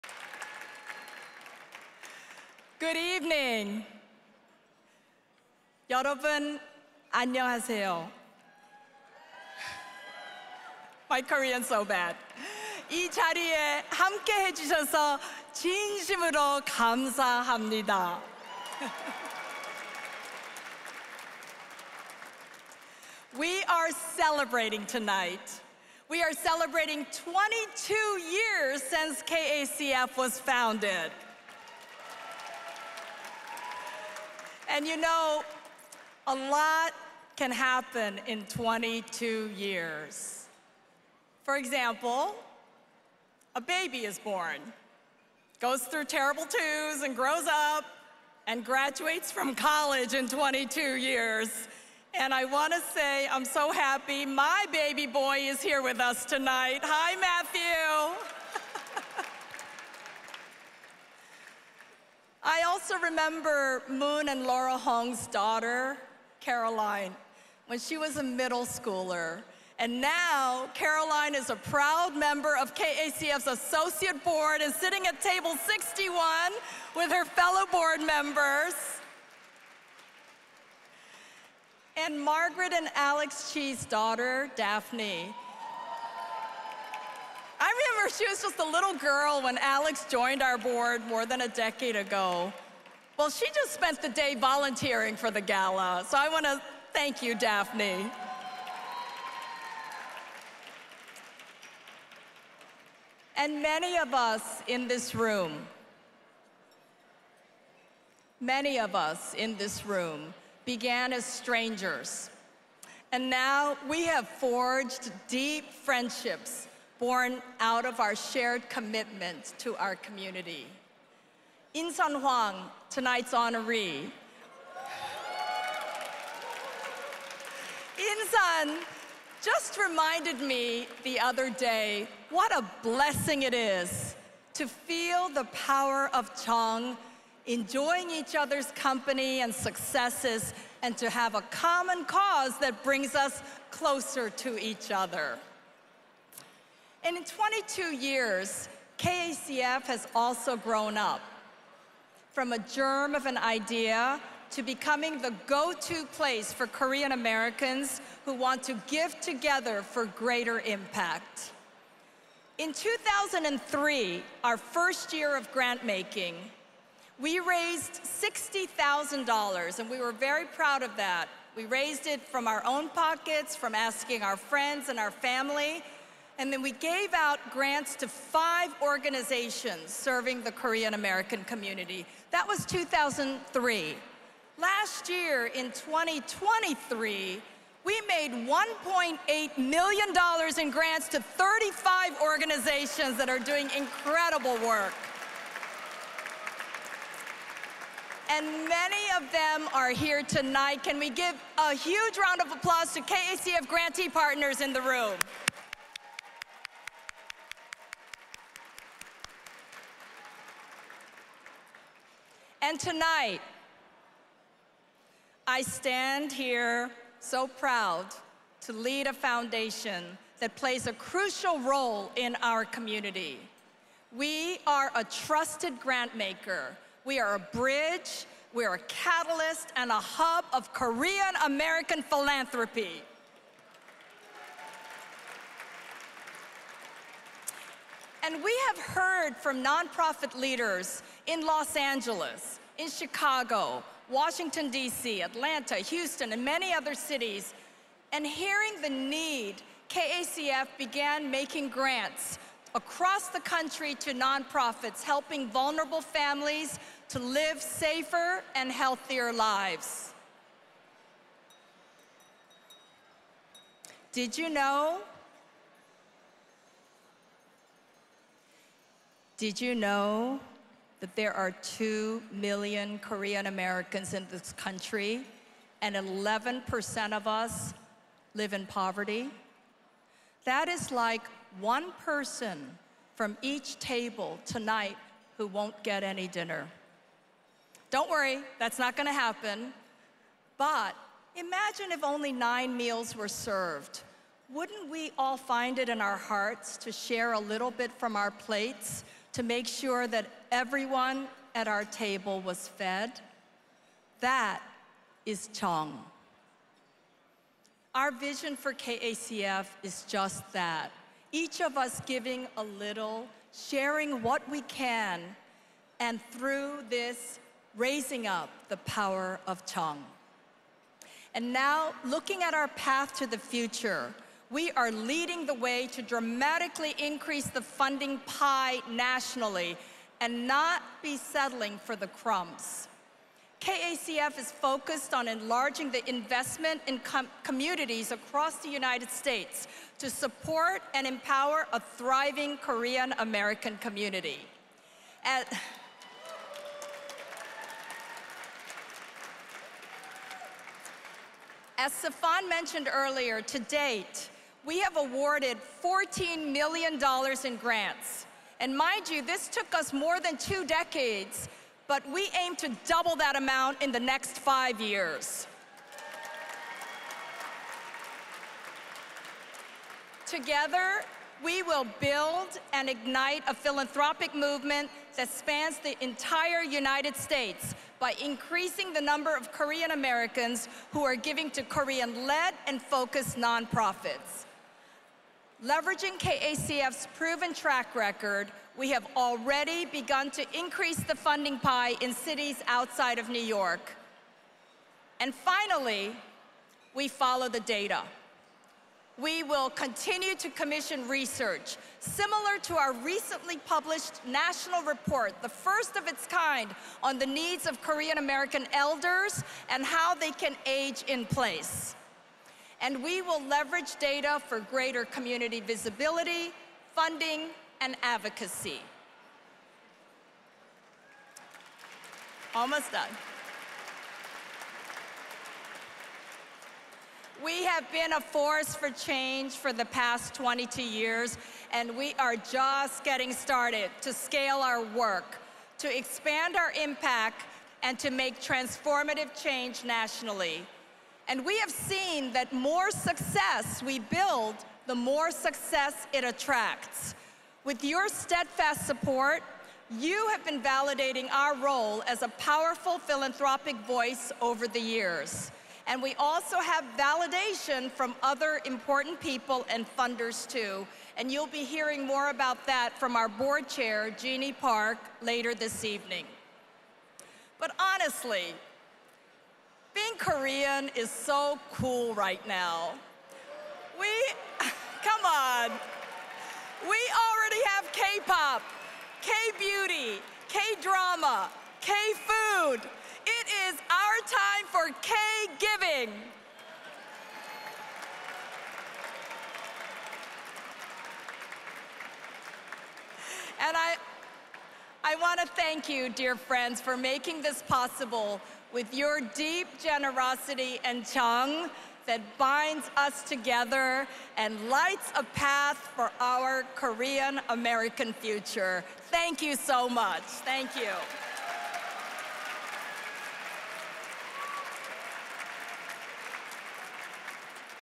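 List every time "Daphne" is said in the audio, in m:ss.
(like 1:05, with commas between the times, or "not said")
1:24, 1:37.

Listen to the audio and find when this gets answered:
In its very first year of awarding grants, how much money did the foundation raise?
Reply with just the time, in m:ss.
2:48.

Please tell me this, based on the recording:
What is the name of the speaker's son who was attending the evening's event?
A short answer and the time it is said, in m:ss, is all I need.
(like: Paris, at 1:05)
Matthew, at 0:57.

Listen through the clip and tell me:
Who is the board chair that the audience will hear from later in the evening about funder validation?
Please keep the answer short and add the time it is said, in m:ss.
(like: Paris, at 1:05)
Jeannie Park, at 7:44.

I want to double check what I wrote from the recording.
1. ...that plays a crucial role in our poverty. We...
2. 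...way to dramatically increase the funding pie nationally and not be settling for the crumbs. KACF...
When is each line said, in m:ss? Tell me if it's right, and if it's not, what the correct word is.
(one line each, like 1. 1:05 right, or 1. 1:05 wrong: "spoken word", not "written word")
1. 3:40 wrong: "community", not "poverty"
2. 5:25 right.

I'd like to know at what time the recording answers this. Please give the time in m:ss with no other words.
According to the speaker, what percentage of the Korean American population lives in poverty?
4:35.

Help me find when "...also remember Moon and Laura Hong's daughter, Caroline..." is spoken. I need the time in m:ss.
1:02.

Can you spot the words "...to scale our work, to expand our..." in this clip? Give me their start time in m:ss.
7:14.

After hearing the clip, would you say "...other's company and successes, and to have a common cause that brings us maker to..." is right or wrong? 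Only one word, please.
wrong.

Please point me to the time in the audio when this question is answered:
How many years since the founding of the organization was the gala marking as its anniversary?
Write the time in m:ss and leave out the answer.
0:27.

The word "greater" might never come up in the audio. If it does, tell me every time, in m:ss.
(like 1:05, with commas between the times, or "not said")
2:40, 6:54.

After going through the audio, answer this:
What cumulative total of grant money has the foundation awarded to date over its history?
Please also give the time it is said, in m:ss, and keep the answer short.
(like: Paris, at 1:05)
$14 million, at 5:55.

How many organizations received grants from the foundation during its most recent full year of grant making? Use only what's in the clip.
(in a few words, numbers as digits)
35.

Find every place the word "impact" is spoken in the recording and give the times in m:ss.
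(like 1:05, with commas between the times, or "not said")
2:40, 7:16.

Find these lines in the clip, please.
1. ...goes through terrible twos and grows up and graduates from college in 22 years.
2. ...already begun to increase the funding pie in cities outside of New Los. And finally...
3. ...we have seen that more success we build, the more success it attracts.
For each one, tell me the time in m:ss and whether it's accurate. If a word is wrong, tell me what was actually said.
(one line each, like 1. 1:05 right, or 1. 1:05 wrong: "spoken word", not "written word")
1. 0:45 right
2. 6:29 wrong: "York", not "Los"
3. 7:21 right.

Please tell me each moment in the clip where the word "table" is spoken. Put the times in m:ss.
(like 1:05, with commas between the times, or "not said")
1:15, 4:43, 5:01.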